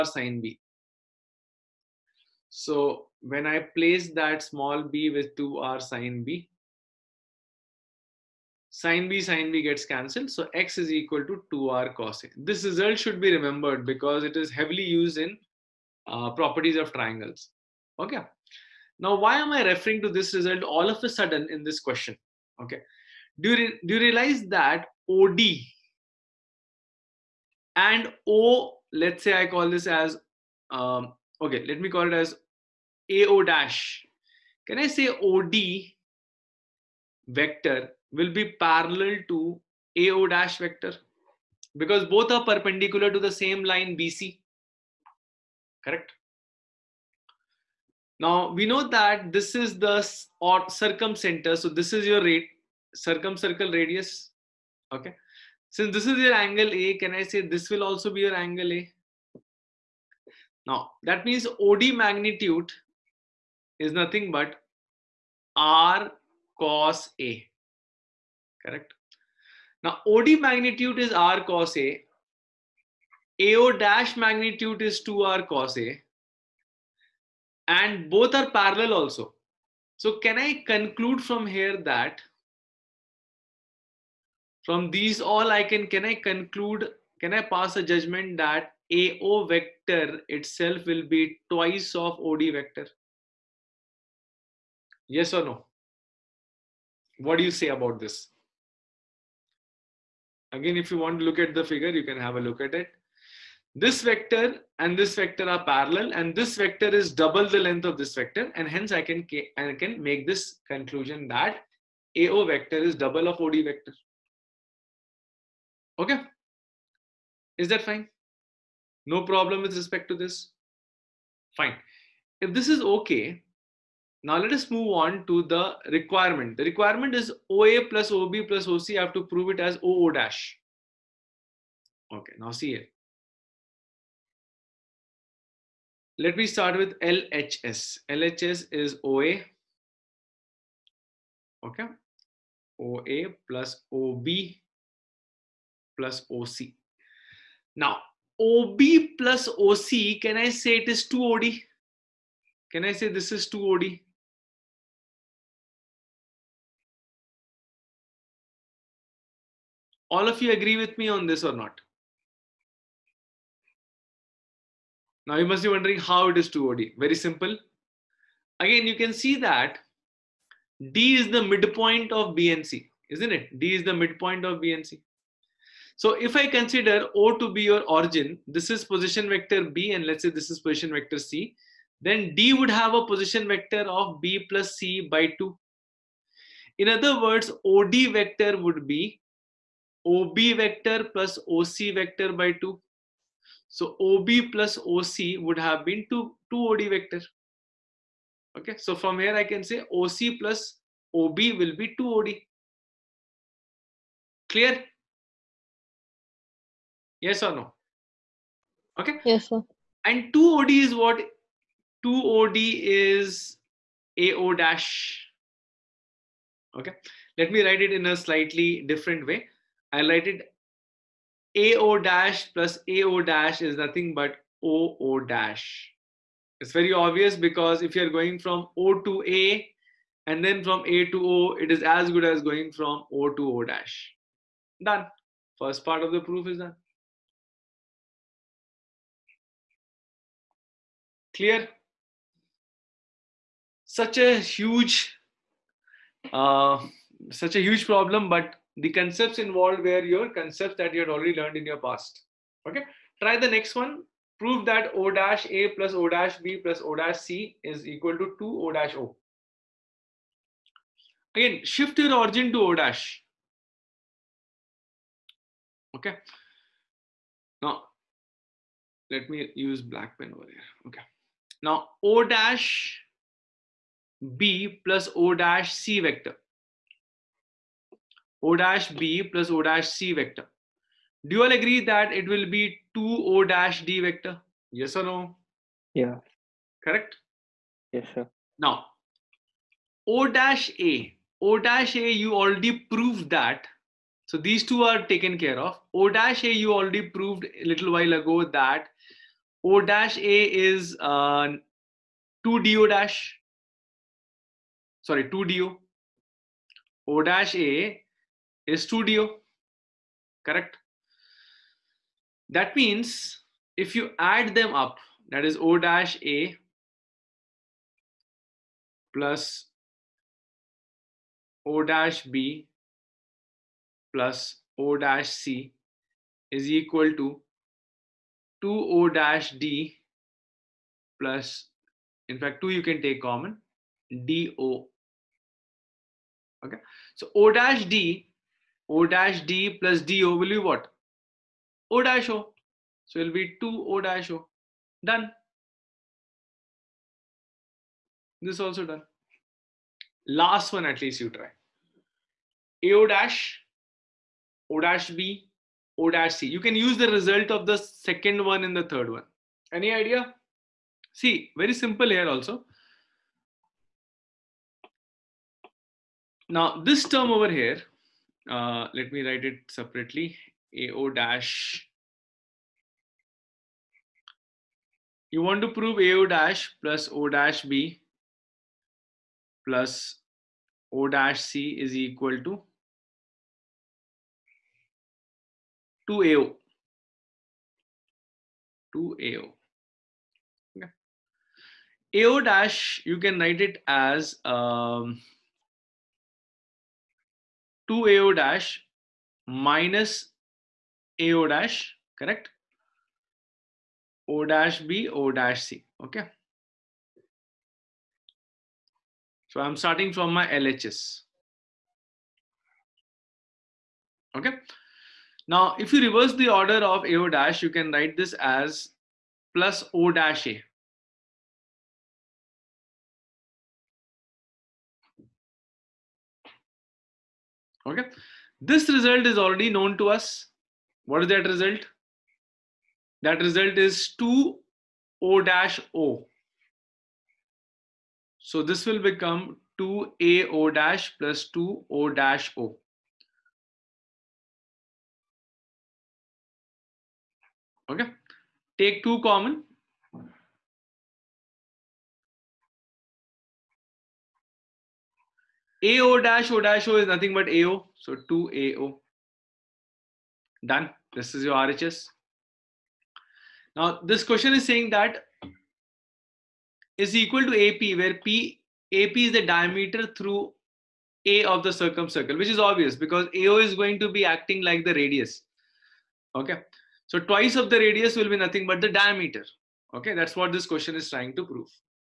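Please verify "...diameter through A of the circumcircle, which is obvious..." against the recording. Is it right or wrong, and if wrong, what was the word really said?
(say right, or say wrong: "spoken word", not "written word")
right.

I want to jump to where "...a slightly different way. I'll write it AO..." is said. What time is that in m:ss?
3:38.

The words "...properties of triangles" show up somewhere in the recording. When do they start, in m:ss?
0:16.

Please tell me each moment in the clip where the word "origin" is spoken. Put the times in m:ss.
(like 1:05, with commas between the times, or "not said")
2:57, 4:22.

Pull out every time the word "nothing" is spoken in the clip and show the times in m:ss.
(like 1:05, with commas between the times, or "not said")
1:03, 3:43, 7:37, 7:58.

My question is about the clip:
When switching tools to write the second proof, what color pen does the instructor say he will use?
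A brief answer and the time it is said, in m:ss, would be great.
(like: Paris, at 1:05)
black, at 4:29.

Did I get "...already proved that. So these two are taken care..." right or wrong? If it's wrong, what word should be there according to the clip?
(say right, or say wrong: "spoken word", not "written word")
right.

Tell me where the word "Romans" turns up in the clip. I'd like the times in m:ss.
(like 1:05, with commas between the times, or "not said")
not said.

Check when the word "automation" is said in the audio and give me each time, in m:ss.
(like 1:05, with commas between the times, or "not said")
not said.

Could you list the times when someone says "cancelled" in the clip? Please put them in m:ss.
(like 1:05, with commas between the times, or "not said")
0:09.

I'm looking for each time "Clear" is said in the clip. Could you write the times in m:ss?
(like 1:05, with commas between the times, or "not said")
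3:24, 4:01.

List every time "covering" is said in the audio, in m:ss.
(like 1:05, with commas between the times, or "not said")
not said.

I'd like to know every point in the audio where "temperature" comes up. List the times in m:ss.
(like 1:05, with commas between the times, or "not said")
not said.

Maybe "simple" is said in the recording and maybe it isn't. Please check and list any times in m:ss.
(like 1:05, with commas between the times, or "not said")
2:47, 6:01.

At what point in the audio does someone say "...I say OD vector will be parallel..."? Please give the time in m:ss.
0:34.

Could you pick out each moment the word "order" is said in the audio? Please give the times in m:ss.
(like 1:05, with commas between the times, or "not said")
6:56.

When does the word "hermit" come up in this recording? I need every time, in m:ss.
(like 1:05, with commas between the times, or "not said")
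not said.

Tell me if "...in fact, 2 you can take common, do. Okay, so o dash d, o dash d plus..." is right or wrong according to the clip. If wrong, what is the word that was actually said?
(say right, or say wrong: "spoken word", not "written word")
right.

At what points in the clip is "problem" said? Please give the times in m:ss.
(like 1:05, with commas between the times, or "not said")
1:59, 4:07.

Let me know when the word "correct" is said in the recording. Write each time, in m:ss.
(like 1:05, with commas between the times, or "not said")
0:45, 1:08, 4:46, 5:10, 6:42.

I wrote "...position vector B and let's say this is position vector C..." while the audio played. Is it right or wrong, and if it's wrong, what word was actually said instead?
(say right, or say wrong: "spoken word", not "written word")
right.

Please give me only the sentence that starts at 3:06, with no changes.
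In other words, OD vector would be OB vector plus OC vector by 2.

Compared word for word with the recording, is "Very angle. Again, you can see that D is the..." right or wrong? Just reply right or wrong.
wrong.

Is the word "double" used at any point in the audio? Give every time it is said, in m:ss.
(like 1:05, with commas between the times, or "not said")
1:47, 1:52.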